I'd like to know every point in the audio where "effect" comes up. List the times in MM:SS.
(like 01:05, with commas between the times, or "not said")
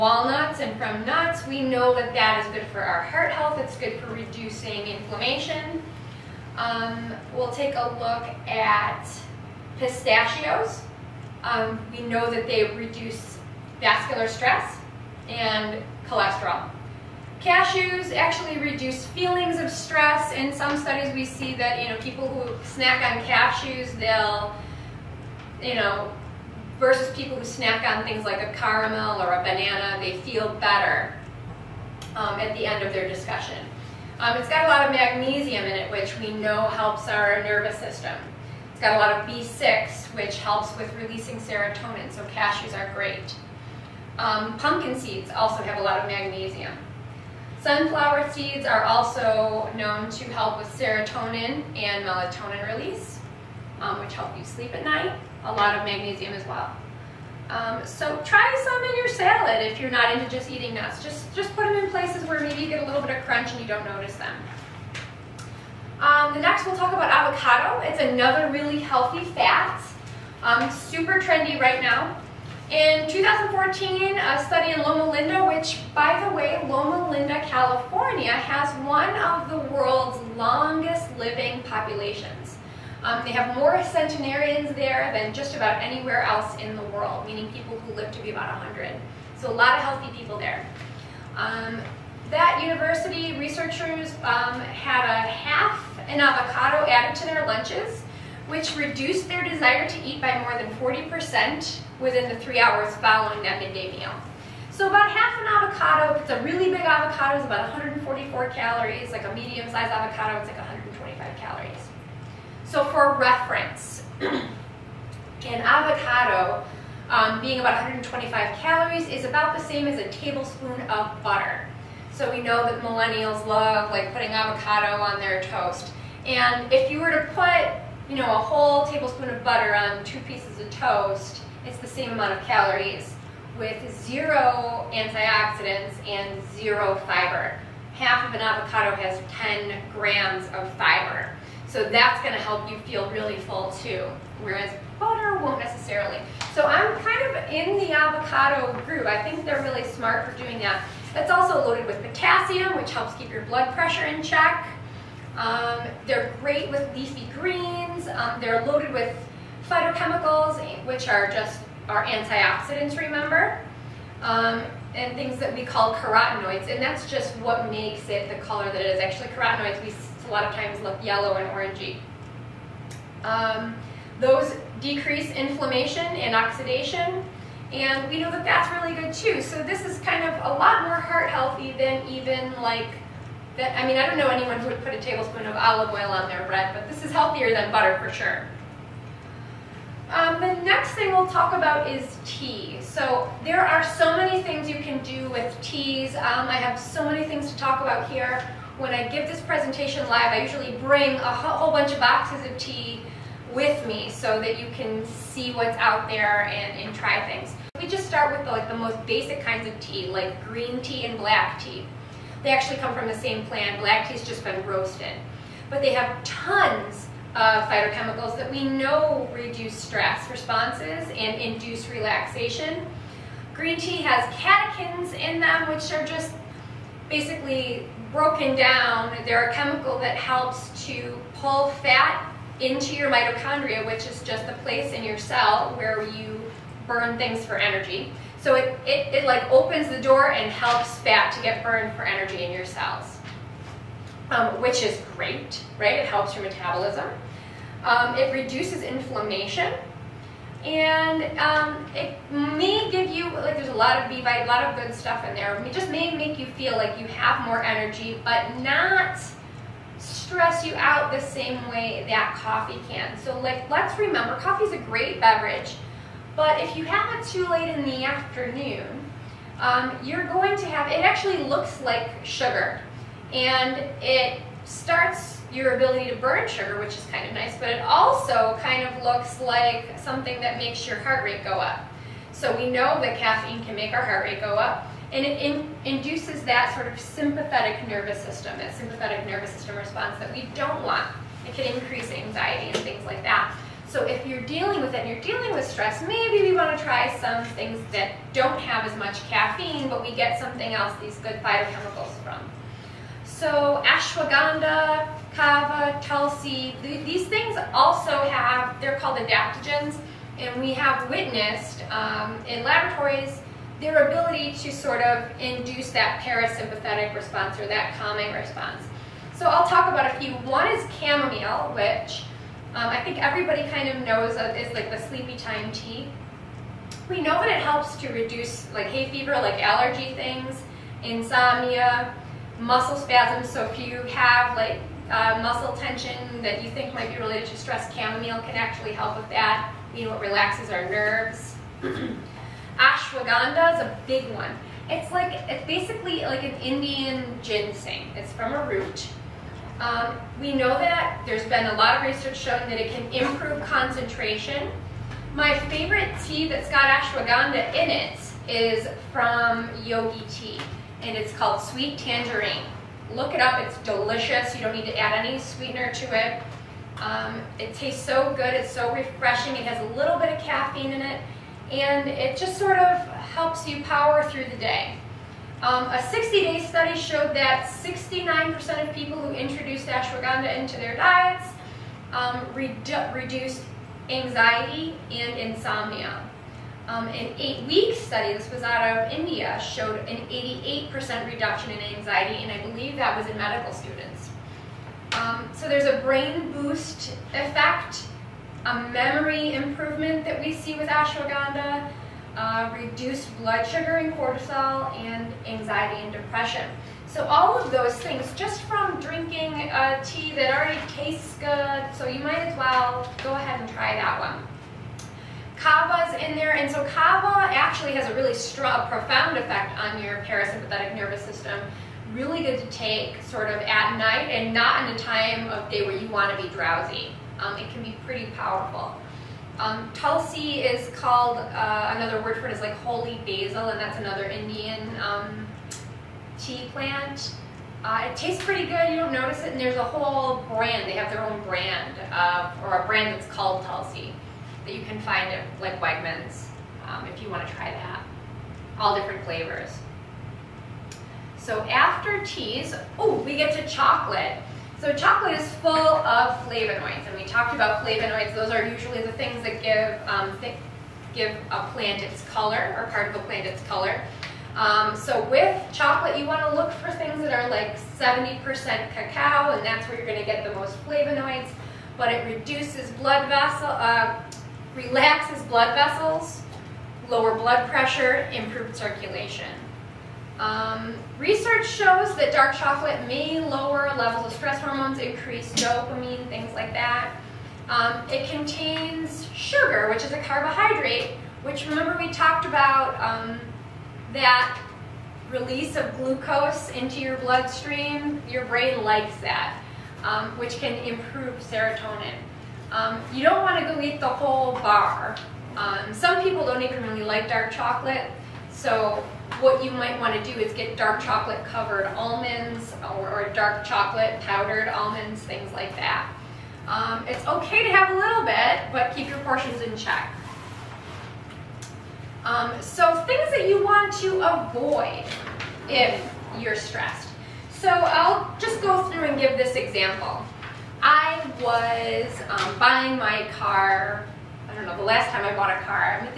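06:37, 06:59.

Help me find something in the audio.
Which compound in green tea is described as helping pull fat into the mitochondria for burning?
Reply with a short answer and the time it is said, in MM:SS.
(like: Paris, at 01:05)
Catechins, at 03:44.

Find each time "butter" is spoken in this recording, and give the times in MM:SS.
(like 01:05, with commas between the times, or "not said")
02:01, 02:09, 02:24, 03:07.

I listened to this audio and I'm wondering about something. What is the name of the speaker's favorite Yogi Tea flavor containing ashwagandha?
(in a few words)
Sweet Tangerine.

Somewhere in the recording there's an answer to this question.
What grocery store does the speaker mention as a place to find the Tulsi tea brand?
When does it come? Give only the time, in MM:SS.
07:25.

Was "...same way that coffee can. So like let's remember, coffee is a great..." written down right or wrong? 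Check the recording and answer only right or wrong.
right.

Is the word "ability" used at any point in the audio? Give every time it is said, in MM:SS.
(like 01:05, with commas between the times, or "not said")
04:35, 05:14.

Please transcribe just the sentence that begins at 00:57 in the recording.
Um, so try some in your salad if you're not into just eating nuts.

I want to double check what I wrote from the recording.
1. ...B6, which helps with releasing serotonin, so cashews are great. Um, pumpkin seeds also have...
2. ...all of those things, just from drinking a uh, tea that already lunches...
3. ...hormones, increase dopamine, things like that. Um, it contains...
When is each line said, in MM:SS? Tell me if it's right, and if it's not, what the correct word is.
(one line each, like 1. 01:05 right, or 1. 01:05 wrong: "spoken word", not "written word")
1. 00:39 right
2. 06:47 wrong: "tastes", not "lunches"
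3. 08:04 right.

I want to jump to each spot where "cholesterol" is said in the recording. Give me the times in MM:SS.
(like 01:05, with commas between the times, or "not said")
00:16.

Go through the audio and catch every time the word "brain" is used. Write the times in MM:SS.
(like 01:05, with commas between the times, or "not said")
06:36, 08:18.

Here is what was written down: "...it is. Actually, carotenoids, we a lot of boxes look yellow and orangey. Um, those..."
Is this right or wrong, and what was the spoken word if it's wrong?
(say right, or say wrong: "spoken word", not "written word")
wrong: "times", not "boxes".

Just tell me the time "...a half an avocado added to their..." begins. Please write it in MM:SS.
01:35.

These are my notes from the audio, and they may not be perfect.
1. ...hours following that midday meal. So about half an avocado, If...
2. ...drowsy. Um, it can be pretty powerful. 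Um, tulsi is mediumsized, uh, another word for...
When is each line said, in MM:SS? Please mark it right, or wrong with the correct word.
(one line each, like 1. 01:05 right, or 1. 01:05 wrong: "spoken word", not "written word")
1. 01:42 right
2. 07:06 wrong: "called", not "mediumsized".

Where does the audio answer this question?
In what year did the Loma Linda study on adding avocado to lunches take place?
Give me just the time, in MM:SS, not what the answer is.
01:13.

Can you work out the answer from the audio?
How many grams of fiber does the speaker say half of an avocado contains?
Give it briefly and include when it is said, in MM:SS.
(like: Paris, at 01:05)
10 grams, at 02:19.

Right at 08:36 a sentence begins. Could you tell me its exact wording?
Um, it's okay to have a little bit, but keep your portions in check.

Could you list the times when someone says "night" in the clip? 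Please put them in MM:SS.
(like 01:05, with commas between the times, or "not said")
00:54, 07:03.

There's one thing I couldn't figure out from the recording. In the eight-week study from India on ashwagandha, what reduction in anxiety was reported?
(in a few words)
88%.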